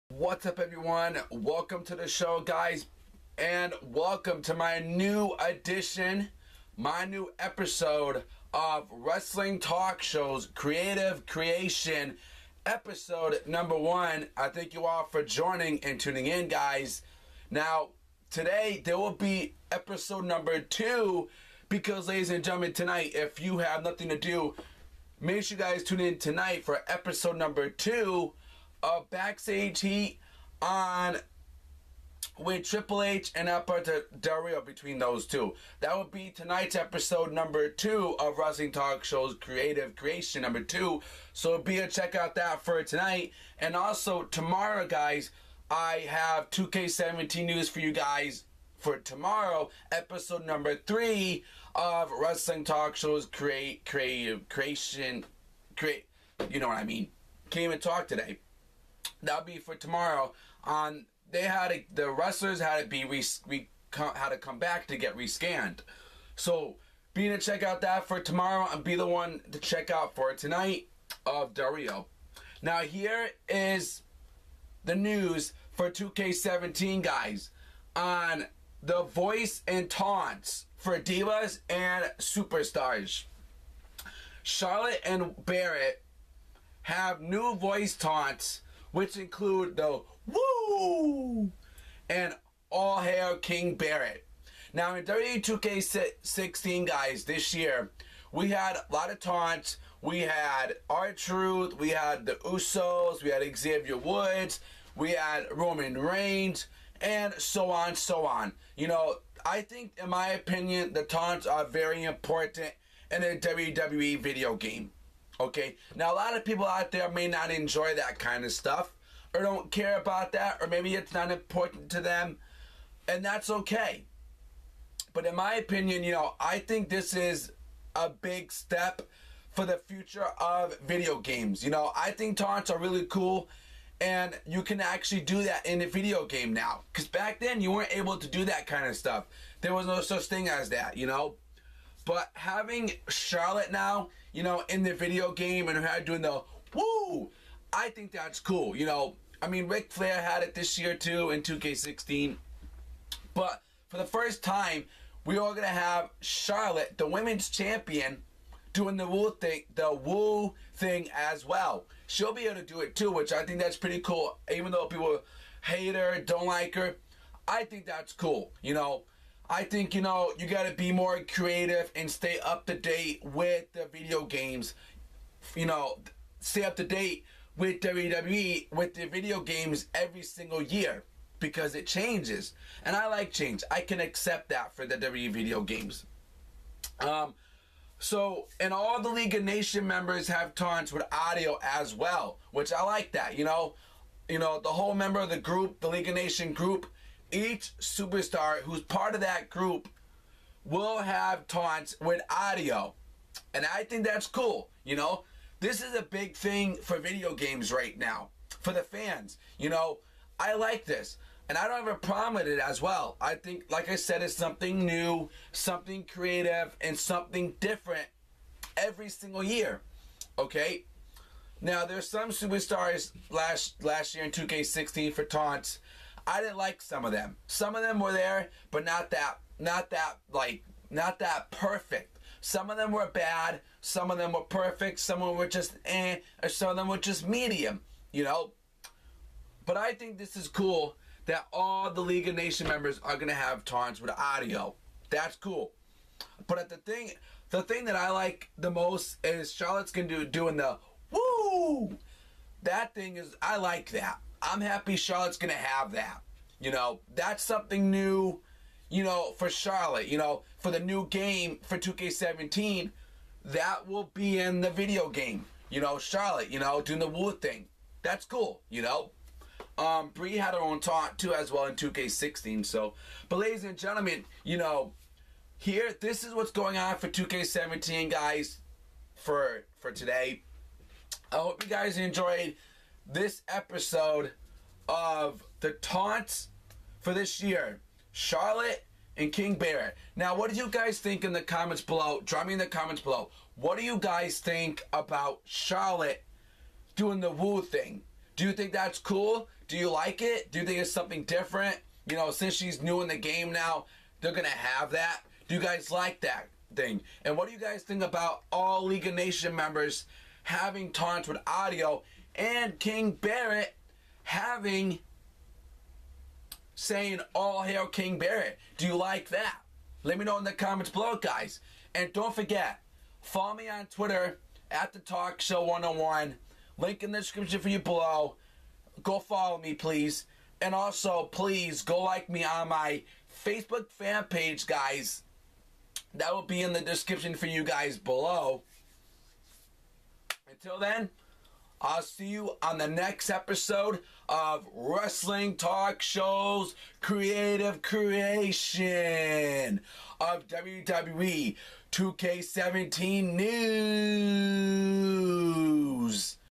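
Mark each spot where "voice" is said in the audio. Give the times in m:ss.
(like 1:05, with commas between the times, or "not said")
1:19, 1:27.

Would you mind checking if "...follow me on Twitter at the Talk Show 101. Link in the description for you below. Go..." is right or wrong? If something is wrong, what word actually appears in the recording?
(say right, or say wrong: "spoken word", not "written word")
right.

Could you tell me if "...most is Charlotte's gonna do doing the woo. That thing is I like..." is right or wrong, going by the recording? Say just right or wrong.
right.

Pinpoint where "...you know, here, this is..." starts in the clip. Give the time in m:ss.
4:34.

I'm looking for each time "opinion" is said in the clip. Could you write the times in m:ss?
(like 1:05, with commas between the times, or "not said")
1:50, 2:05.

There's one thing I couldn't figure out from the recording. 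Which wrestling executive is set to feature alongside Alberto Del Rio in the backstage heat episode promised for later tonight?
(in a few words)
Triple H.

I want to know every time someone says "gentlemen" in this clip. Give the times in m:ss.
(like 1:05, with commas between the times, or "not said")
0:22, 4:33.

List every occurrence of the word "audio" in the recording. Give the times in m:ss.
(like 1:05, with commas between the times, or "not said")
3:11, 3:22, 4:04, 5:11.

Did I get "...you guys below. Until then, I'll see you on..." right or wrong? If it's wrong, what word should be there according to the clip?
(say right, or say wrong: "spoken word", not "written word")
right.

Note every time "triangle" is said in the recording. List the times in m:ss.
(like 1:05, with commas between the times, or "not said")
not said.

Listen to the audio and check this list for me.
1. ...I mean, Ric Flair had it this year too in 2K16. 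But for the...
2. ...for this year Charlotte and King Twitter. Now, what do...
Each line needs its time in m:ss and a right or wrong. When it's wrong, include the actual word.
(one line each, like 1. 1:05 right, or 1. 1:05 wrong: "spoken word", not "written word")
1. 2:29 right
2. 4:46 wrong: "Barrett", not "Twitter".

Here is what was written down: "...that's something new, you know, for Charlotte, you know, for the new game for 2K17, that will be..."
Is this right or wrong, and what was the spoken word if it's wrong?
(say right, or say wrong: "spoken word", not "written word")
right.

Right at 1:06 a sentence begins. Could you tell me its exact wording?
So be to check out that for tomorrow and be the one to check out for tonight of Dario.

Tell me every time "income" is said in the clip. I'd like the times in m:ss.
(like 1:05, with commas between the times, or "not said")
not said.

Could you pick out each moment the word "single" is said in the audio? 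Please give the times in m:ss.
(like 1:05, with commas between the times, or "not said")
3:00, 3:39.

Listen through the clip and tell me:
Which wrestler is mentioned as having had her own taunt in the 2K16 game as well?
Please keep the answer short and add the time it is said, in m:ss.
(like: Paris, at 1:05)
Brie, at 4:30.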